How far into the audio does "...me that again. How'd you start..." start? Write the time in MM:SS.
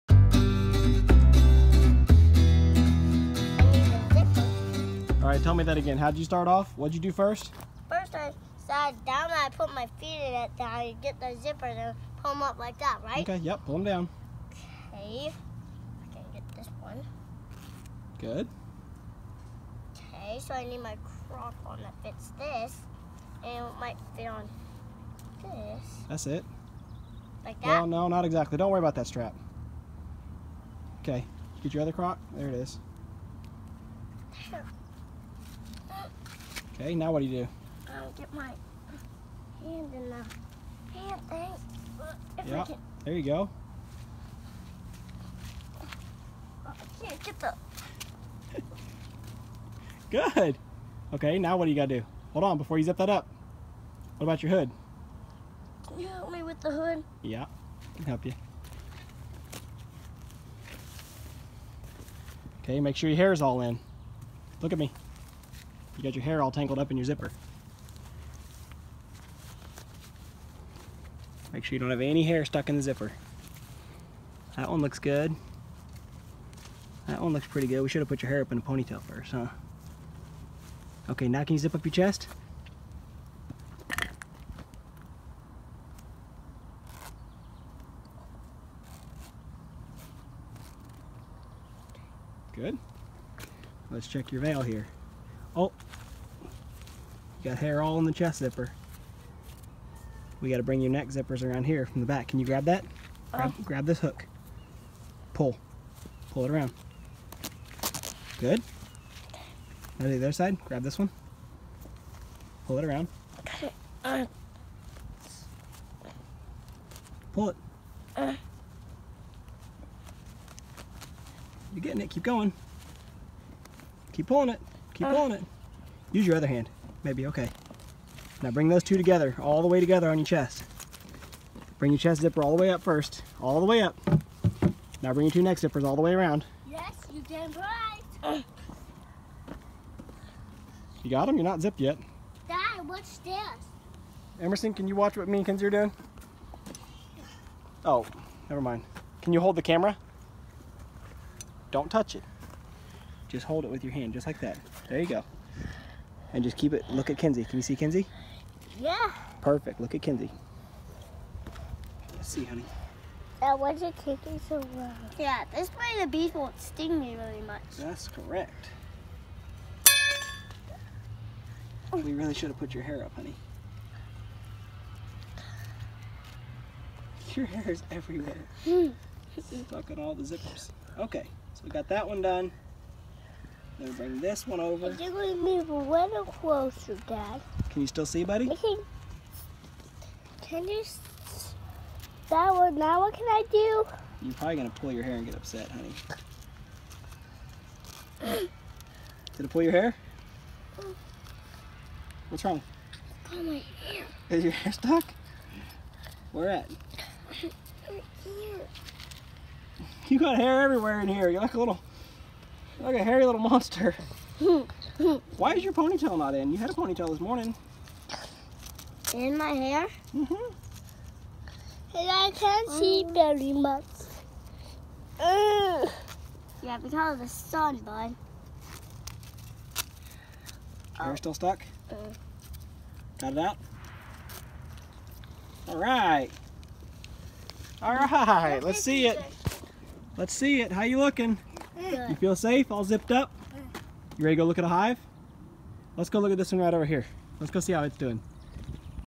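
00:05.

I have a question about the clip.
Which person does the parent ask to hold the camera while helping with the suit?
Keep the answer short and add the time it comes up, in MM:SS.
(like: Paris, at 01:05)
Emerson, at 02:24.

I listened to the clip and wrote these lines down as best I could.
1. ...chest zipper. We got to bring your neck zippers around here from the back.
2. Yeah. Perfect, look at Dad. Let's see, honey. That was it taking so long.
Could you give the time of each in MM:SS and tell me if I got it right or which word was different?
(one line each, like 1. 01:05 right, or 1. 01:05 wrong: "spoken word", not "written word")
1. 01:38 right
2. 02:38 wrong: "Kinsey", not "Dad".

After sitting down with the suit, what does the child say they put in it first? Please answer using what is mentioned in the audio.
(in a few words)
My feet.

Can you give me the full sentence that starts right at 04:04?
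You ready to go look at a hive?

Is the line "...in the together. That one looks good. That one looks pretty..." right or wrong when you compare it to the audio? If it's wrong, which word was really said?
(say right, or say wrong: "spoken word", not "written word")
wrong: "zipper", not "together".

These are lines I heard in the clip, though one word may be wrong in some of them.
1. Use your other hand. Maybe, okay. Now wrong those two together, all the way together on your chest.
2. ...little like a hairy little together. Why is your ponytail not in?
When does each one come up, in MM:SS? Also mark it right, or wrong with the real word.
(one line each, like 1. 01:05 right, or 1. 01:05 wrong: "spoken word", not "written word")
1. 02:06 wrong: "bring", not "wrong"
2. 03:31 wrong: "monster", not "together".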